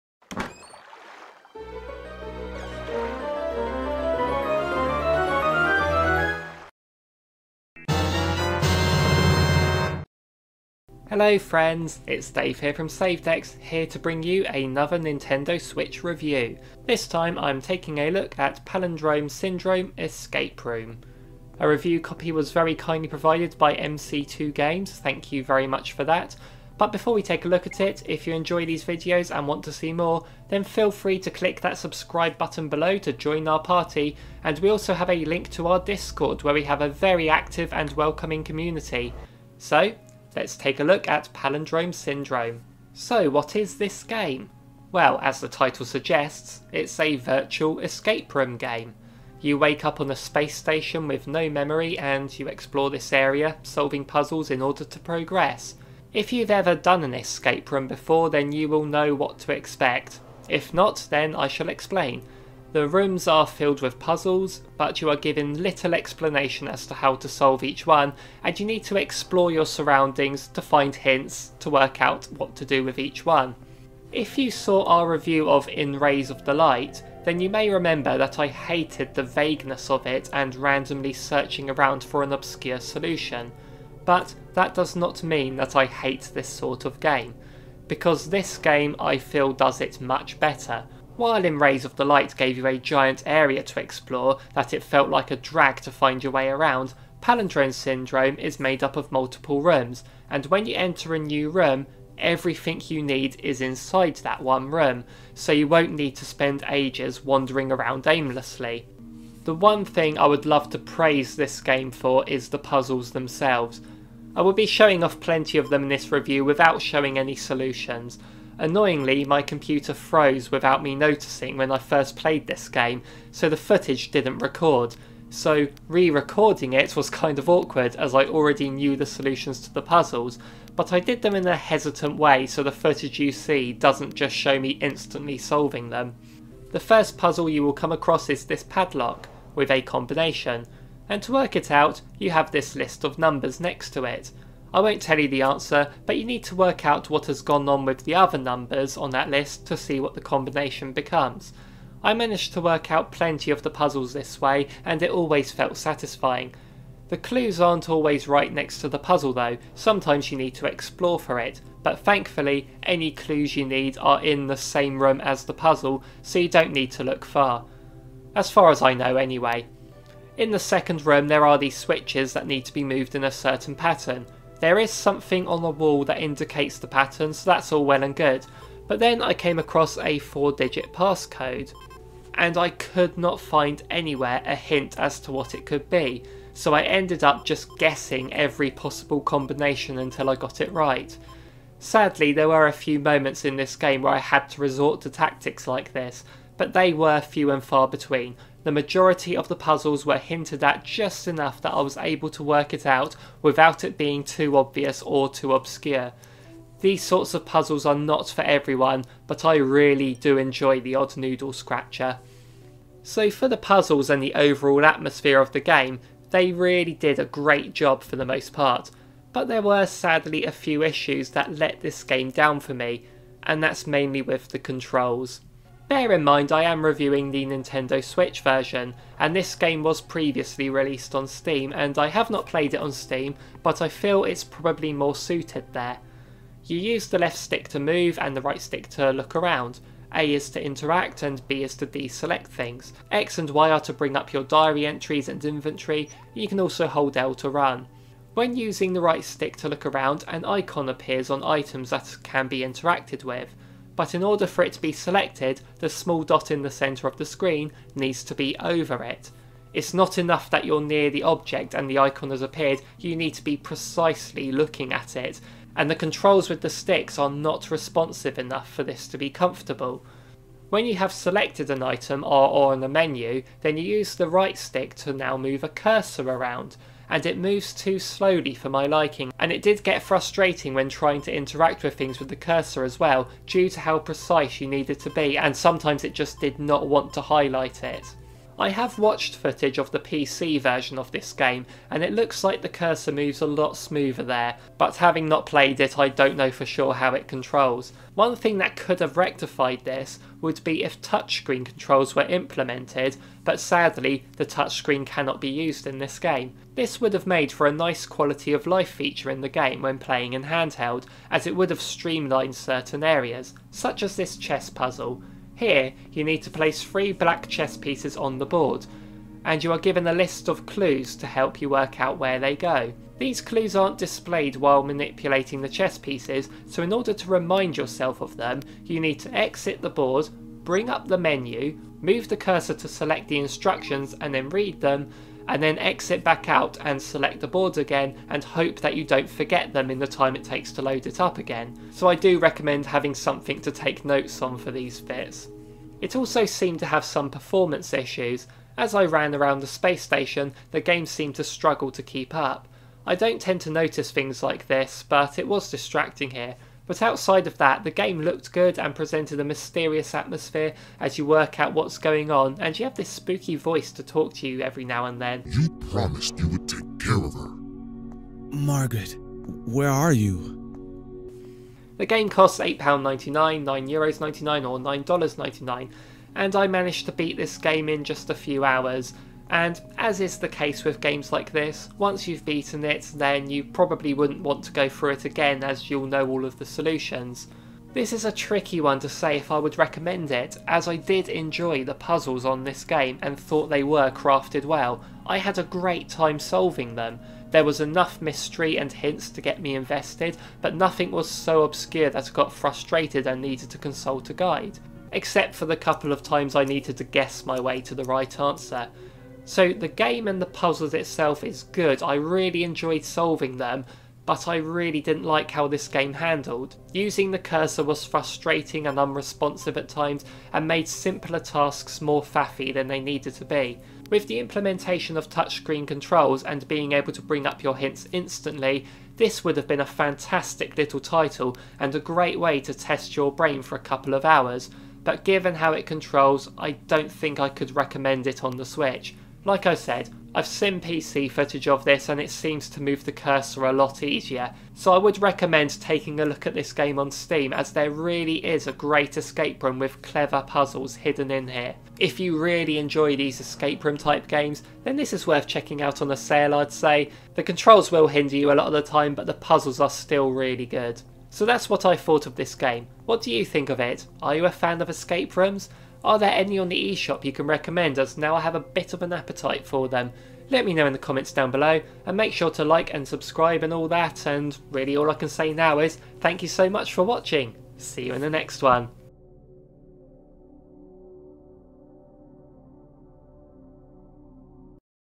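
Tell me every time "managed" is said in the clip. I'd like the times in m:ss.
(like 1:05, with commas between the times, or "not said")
2:32, 6:16.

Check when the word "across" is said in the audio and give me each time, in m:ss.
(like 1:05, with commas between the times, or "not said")
2:17, 2:59.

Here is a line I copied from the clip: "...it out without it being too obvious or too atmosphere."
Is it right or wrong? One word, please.
wrong.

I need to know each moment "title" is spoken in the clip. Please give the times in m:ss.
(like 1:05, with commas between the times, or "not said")
0:45, 7:10.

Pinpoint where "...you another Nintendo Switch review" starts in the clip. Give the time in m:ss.
0:14.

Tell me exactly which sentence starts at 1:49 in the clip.
The one thing I would love to praise this game for is the puzzles themselves.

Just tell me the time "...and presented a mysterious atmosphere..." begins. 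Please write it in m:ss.
5:58.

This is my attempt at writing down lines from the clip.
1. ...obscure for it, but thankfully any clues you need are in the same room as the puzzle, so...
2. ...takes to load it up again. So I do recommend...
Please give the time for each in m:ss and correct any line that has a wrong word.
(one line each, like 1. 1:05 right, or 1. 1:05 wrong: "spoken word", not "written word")
1. 2:40 wrong: "explore", not "obscure"
2. 5:40 right.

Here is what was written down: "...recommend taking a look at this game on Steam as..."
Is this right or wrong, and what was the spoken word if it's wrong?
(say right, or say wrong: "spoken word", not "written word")
right.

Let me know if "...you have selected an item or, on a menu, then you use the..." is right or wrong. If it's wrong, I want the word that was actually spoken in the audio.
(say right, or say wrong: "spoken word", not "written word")
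right.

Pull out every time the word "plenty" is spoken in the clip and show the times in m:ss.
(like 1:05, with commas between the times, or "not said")
1:55, 2:33.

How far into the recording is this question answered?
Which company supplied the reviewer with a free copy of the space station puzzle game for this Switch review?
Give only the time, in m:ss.
0:23.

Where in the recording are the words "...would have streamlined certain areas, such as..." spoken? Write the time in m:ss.
5:11.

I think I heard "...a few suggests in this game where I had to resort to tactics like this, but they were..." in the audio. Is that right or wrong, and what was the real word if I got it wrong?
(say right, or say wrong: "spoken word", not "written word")
wrong: "moments", not "suggests".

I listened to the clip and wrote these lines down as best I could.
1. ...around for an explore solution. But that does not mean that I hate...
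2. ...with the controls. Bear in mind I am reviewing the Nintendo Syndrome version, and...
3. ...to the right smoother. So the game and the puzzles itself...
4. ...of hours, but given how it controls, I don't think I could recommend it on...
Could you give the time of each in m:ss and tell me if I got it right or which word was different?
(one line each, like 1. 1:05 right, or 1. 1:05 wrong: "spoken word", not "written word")
1. 1:21 wrong: "obscure", not "explore"
2. 3:44 wrong: "Switch", not "Syndrome"
3. 6:47 wrong: "answer", not "smoother"
4. 7:14 right.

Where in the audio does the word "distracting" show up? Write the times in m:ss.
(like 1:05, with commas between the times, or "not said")
5:55.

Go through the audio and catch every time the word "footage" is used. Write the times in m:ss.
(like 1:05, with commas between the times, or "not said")
2:03, 2:12, 4:49, 7:21.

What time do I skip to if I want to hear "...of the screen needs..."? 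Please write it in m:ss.
4:17.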